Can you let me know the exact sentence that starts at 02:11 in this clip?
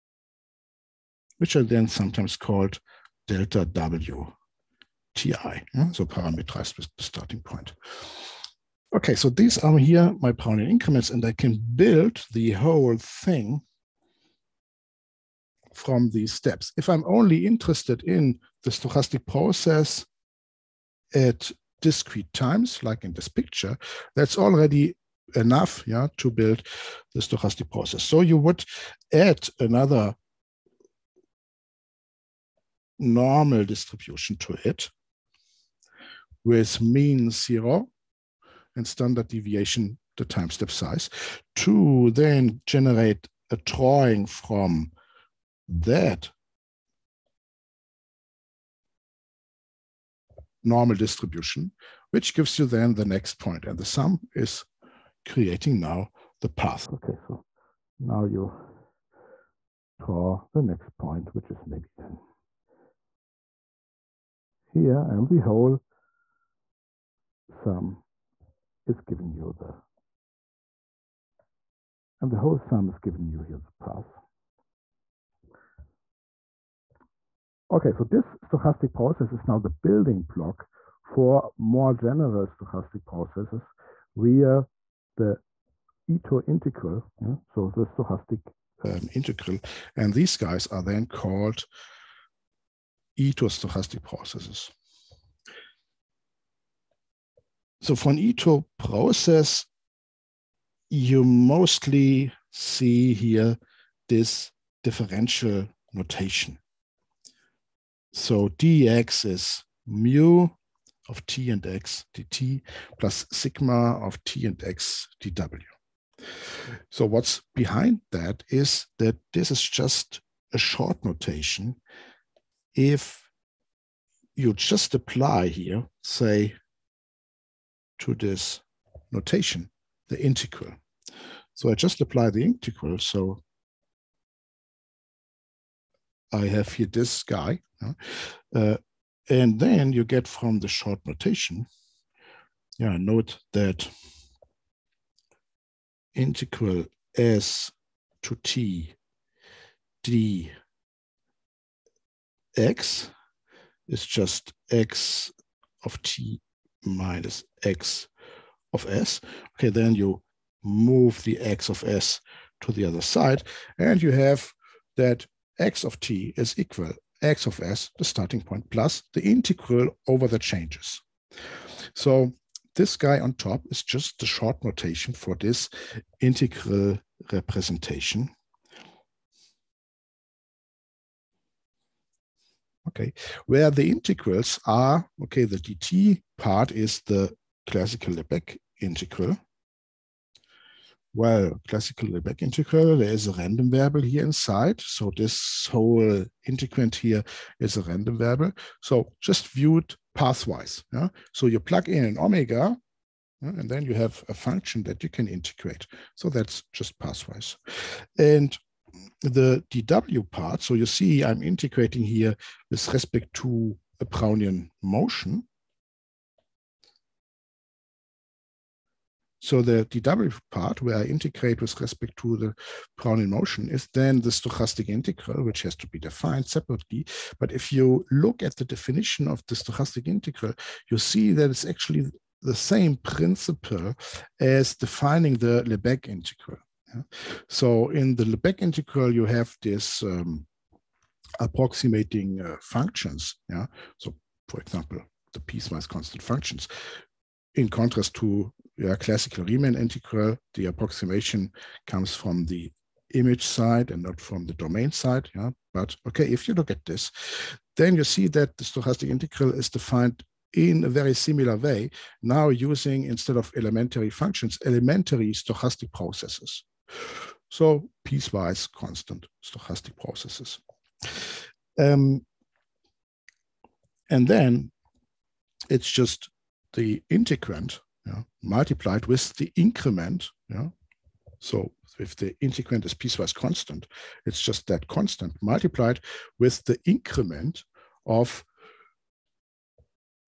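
So I just apply the integral.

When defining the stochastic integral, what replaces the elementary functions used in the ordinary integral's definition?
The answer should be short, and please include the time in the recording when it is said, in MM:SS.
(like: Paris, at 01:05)
elementary stochastic processes, at 04:24.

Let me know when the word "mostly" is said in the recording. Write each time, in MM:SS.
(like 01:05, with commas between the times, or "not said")
01:41.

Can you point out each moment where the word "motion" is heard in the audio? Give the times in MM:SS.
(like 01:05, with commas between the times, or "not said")
03:34, 03:43.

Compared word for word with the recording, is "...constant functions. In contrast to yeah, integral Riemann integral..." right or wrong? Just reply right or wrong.
wrong.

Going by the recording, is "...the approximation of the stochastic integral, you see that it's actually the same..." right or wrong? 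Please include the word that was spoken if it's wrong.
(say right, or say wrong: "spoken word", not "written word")
wrong: "definition", not "approximation".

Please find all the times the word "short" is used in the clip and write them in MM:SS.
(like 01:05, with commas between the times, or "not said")
02:00, 02:20, 02:54.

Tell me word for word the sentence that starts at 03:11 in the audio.
Well, classical Lebesgue integral, there is a random variable here inside.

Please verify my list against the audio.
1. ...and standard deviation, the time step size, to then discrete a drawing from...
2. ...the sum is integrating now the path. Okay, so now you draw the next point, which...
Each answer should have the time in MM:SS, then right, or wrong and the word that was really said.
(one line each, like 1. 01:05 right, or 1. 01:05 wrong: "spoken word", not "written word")
1. 00:38 wrong: "generate", not "discrete"
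2. 00:53 wrong: "creating", not "integrating".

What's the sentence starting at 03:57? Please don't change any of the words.
So in the Lebesgue integral, you have this um, approximating uh, functions.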